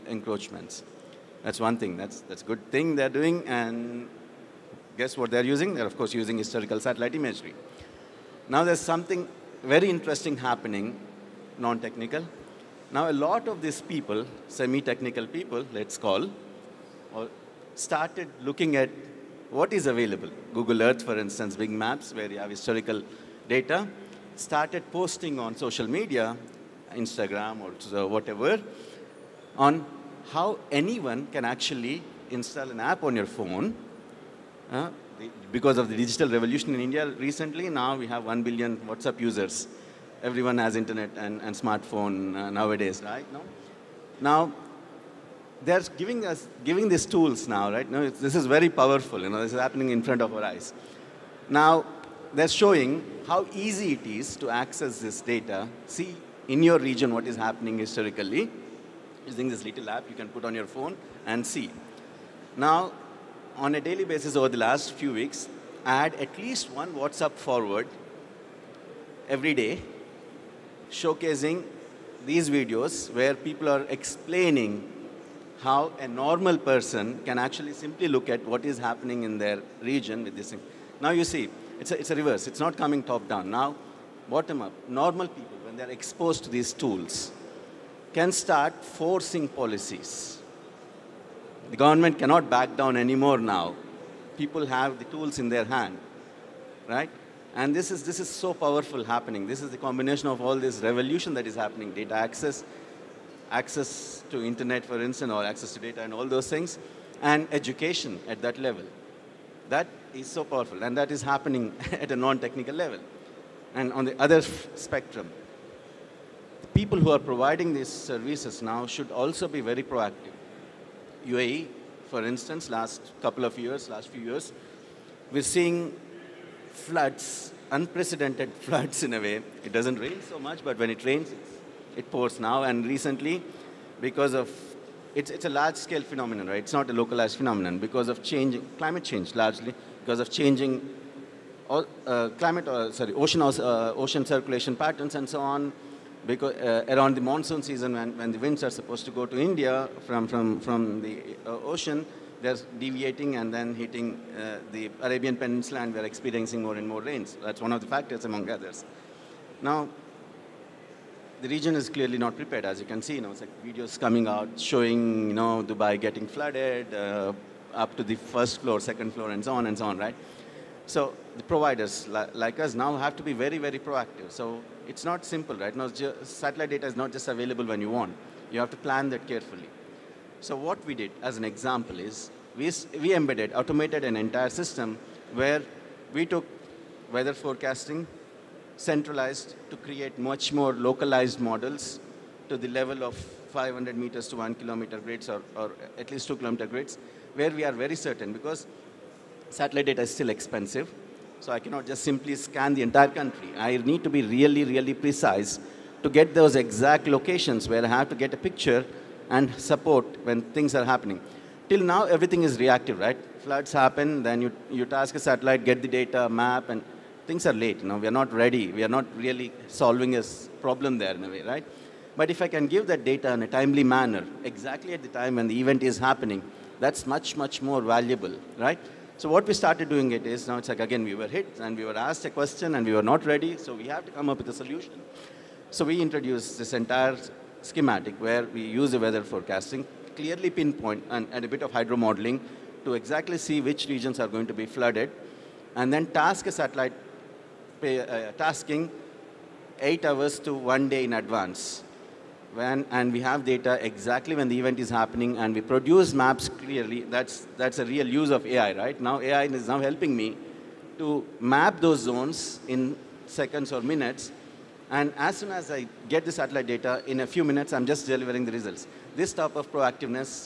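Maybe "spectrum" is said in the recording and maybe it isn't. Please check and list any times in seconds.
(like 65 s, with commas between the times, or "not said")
114 s.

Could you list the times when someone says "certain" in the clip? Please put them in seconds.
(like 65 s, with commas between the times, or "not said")
197 s.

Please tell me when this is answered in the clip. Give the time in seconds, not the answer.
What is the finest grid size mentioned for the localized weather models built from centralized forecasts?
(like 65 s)
193 s.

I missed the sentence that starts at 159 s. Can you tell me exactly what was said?
Now, the region is clearly not prepared.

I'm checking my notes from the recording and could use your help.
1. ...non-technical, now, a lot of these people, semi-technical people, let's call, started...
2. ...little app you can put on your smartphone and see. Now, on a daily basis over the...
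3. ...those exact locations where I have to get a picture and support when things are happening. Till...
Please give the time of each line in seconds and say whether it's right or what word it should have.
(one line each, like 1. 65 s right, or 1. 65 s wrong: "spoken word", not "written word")
1. 11 s right
2. 59 s wrong: "phone", not "smartphone"
3. 206 s right.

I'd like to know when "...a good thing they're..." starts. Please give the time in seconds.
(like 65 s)
2 s.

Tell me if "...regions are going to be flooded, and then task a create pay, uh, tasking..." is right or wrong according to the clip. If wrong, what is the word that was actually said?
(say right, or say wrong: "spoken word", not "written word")
wrong: "satellite", not "create".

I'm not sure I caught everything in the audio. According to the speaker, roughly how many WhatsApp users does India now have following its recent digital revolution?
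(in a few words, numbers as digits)
1 billion.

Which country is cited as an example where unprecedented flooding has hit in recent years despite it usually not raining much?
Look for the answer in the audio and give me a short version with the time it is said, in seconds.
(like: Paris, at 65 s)
UAE, at 121 s.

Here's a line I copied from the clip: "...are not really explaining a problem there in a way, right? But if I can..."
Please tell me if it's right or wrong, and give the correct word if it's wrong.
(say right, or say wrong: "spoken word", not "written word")
wrong: "solving", not "explaining".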